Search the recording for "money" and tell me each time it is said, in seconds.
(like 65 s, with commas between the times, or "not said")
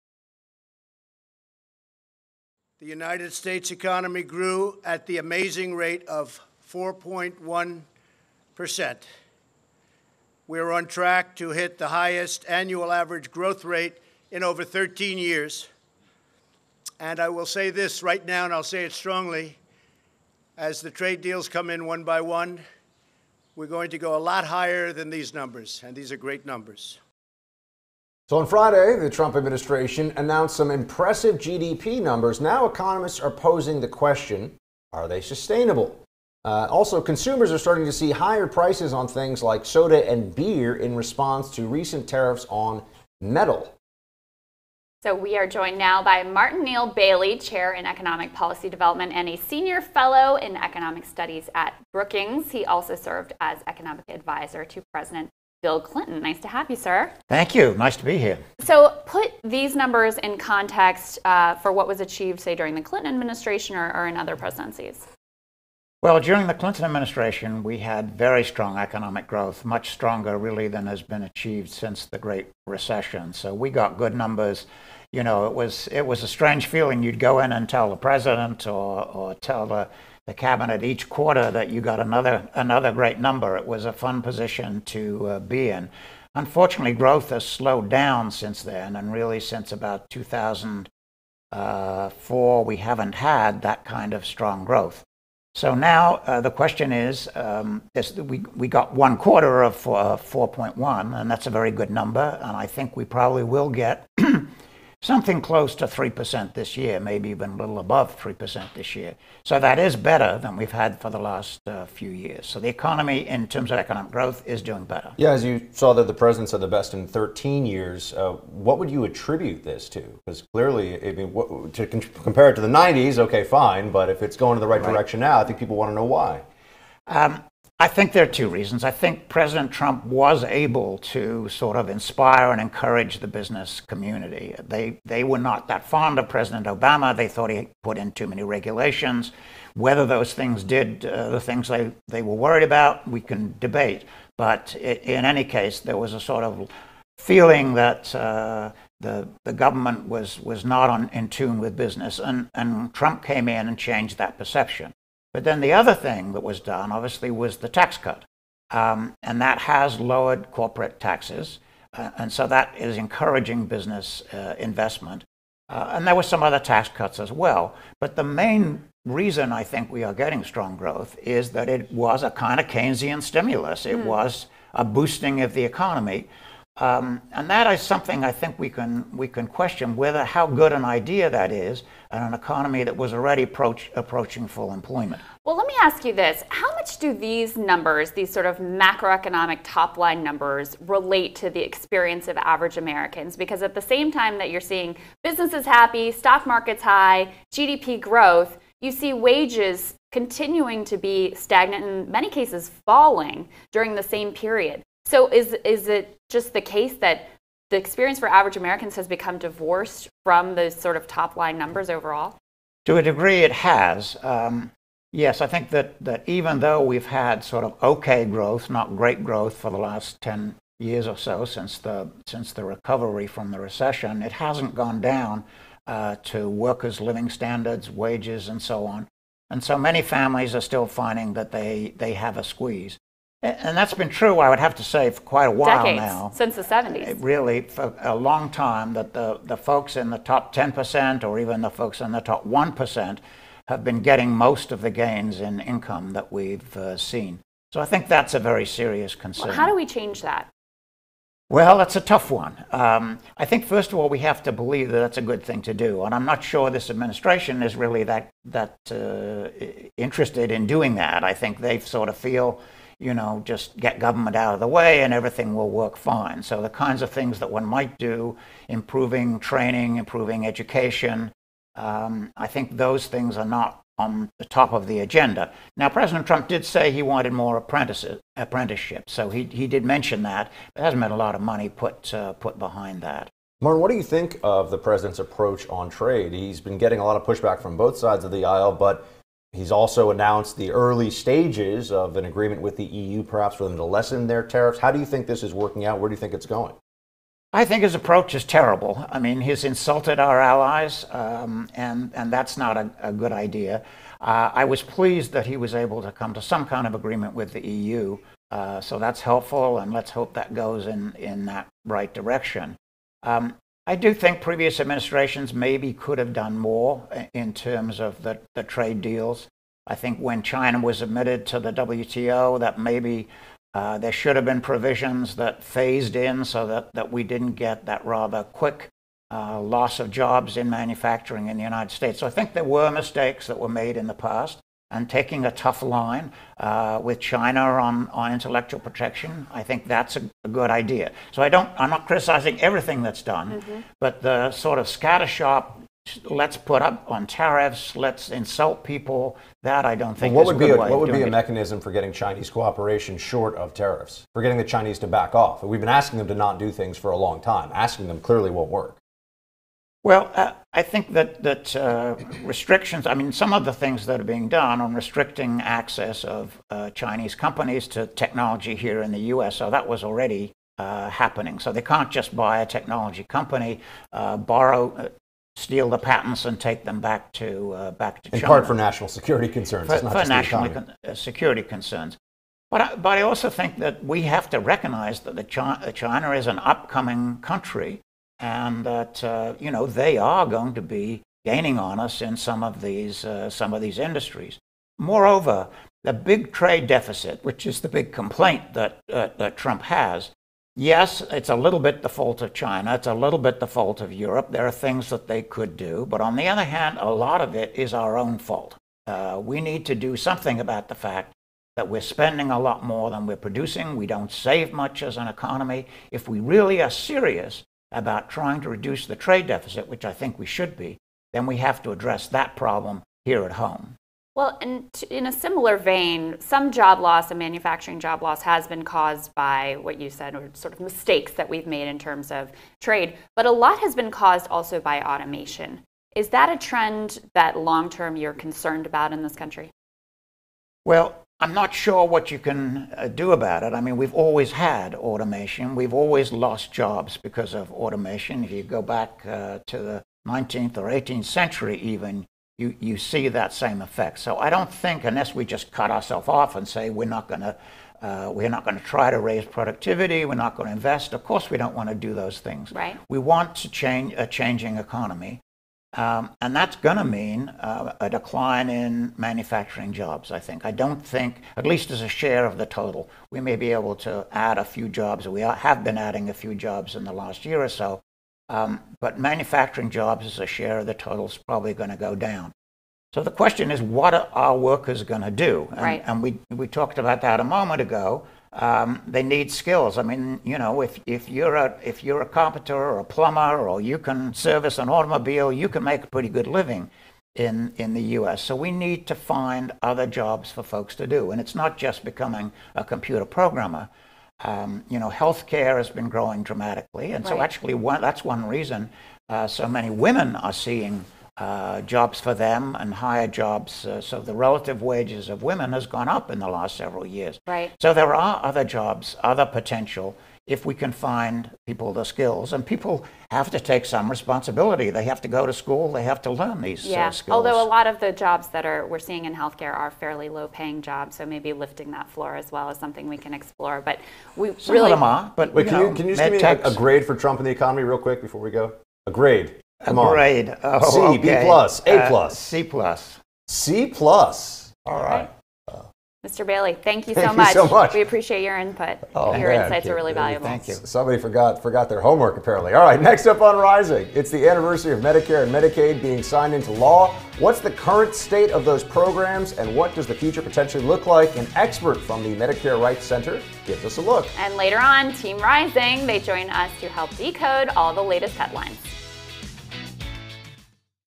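281 s.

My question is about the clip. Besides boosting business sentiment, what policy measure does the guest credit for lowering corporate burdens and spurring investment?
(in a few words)
the tax cut.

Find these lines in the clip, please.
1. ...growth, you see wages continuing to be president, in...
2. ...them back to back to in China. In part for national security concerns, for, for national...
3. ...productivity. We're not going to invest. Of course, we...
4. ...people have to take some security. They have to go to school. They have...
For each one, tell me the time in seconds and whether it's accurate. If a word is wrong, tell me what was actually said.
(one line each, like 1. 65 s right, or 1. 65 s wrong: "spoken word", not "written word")
1. 197 s wrong: "stagnant", not "president"
2. 376 s right
3. 459 s right
4. 522 s wrong: "responsibility", not "security".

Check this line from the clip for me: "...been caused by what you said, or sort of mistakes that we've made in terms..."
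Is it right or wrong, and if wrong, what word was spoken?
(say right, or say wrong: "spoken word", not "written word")
right.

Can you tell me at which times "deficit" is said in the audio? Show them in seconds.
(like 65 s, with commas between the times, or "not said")
396 s, 419 s.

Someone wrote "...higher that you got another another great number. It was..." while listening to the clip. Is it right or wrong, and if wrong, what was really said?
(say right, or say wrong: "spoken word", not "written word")
wrong: "quarter", not "higher".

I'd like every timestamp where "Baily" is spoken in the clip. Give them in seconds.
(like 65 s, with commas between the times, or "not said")
46 s, 546 s.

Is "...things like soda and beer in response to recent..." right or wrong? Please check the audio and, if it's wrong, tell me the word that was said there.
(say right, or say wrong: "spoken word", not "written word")
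right.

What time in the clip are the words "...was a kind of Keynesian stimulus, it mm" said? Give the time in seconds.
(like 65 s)
171 s.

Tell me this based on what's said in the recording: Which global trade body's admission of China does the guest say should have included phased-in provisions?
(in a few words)
WTO.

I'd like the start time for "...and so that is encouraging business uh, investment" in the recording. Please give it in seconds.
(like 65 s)
162 s.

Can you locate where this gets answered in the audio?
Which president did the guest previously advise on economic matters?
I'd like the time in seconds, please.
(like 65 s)
54 s.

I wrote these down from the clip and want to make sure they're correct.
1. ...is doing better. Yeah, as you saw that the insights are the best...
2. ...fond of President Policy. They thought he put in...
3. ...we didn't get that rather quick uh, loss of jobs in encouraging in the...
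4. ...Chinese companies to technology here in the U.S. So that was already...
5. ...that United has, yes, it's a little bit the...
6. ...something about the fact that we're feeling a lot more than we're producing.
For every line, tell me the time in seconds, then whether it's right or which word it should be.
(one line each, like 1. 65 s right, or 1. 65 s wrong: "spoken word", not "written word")
1. 114 s wrong: "presidents", not "insights"
2. 135 s wrong: "Obama", not "Policy"
3. 327 s wrong: "manufacturing", not "encouraging"
4. 366 s right
5. 399 s wrong: "Trump", not "United"
6. 410 s wrong: "spending", not "feeling".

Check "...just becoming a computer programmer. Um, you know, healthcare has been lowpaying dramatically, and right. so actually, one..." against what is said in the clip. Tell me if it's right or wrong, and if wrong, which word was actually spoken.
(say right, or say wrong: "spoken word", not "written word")
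wrong: "growing", not "lowpaying".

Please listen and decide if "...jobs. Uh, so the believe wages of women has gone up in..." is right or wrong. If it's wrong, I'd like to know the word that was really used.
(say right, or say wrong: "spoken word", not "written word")
wrong: "relative", not "believe".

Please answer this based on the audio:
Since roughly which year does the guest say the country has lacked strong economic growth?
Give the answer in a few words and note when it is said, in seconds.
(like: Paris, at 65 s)
2004, at 90 s.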